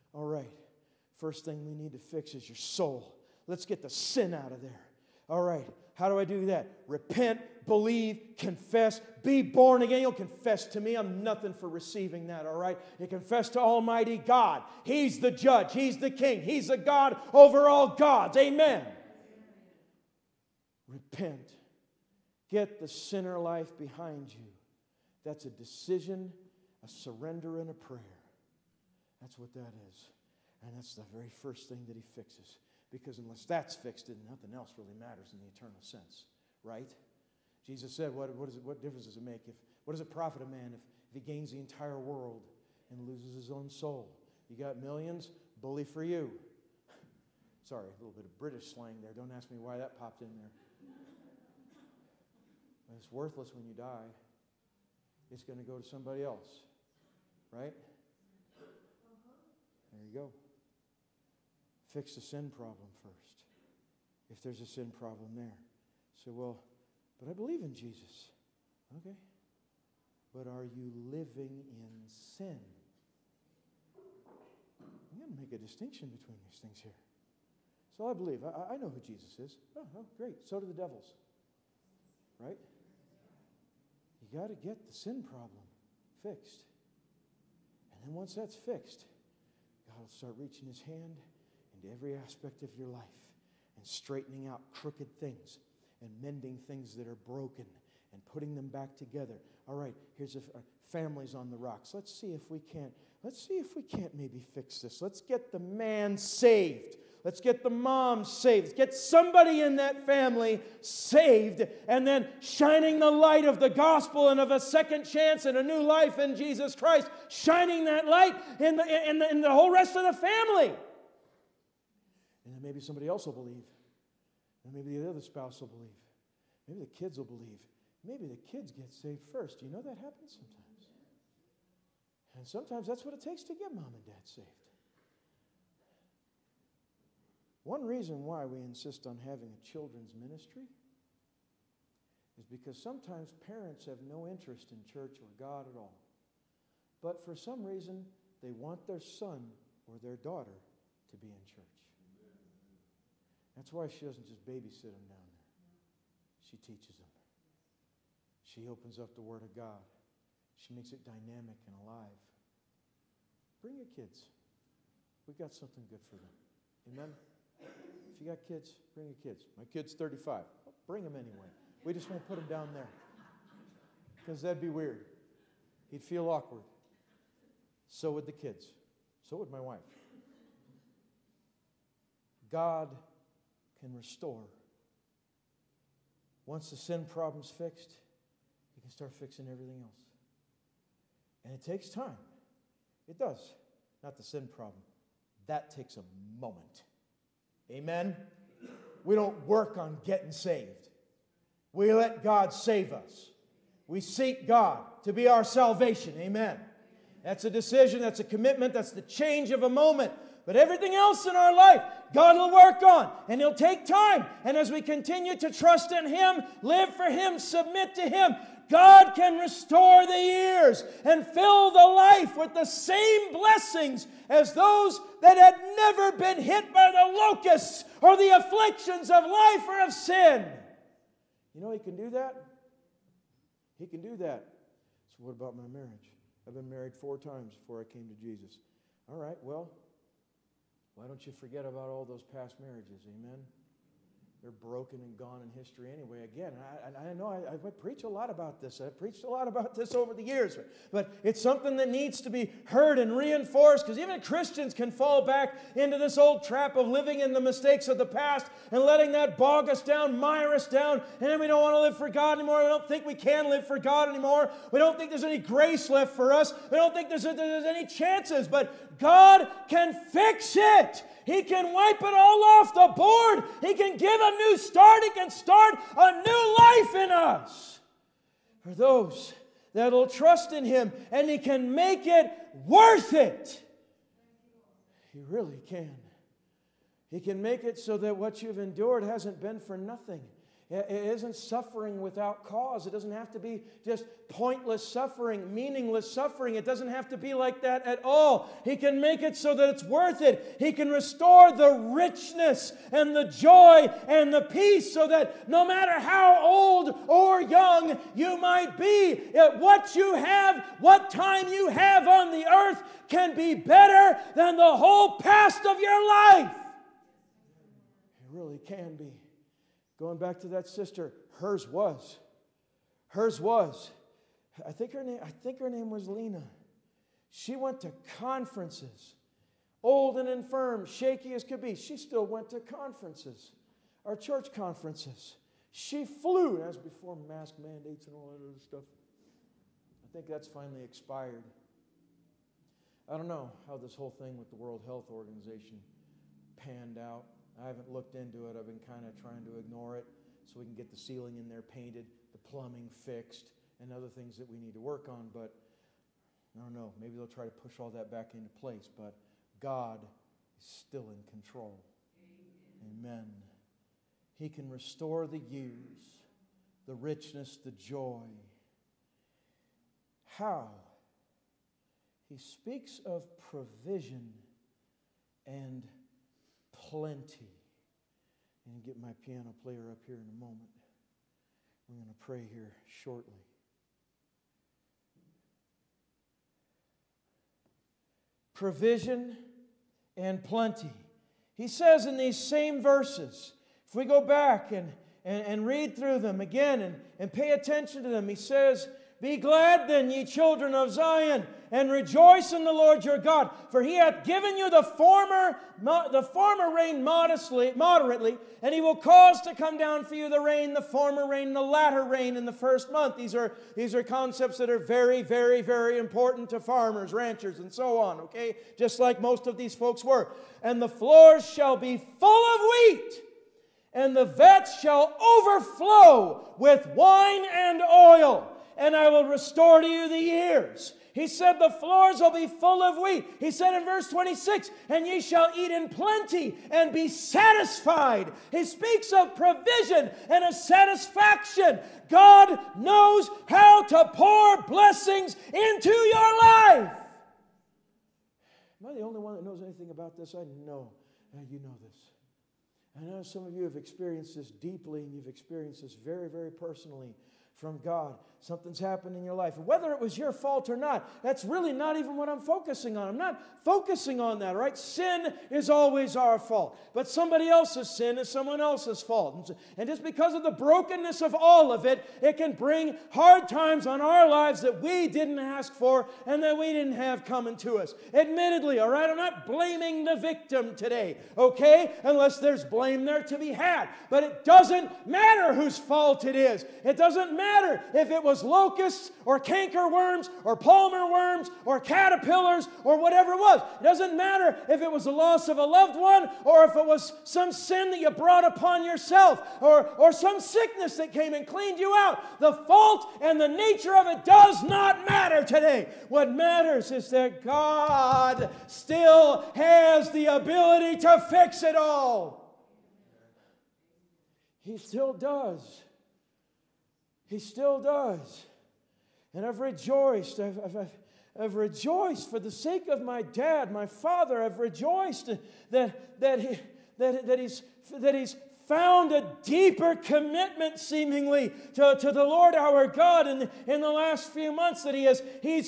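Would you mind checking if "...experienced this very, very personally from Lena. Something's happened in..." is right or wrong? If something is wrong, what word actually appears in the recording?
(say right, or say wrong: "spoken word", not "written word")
wrong: "God", not "Lena".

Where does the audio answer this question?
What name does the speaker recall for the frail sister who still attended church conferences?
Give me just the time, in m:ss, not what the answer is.
5:26.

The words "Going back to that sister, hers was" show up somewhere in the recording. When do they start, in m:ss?
5:19.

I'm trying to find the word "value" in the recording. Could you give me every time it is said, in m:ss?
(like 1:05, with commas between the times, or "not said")
not said.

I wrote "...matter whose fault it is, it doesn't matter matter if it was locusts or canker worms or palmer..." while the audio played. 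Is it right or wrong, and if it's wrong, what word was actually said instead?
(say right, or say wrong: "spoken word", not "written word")
right.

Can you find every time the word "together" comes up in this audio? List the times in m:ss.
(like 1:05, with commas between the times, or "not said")
1:38.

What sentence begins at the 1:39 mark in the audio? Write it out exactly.
All right, here's a family's on the rocks.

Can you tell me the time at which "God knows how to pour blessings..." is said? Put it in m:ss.
7:22.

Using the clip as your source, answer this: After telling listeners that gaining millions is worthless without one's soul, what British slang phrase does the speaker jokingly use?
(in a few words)
bully for you.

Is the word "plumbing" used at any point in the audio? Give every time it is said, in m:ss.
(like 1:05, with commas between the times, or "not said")
5:52.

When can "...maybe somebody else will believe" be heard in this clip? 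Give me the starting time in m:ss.
2:02.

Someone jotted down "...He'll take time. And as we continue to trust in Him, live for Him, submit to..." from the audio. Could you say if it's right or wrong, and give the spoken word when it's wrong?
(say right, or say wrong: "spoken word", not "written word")
right.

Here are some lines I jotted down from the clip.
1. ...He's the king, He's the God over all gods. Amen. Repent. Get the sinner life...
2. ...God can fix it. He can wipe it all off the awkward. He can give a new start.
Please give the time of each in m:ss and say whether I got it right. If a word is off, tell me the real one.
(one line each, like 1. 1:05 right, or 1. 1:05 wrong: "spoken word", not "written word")
1. 0:15 right
2. 4:28 wrong: "board", not "awkward".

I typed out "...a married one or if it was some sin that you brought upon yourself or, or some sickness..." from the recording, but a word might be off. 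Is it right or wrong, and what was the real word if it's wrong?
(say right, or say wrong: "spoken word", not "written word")
wrong: "loved", not "married".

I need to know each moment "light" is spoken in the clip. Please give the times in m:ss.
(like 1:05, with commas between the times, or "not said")
1:53, 1:58.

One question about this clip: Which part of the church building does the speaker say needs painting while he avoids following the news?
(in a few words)
the ceiling.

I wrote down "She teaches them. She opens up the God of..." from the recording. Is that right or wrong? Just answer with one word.
wrong.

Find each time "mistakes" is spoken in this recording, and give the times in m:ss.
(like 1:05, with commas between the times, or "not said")
4:17.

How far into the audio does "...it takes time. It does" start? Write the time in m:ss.
3:11.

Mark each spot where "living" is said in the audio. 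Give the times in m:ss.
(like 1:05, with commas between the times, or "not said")
1:11, 4:16.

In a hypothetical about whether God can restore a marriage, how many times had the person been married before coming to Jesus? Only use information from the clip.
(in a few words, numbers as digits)
4.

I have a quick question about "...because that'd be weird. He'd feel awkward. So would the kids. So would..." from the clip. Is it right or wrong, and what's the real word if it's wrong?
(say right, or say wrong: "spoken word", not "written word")
right.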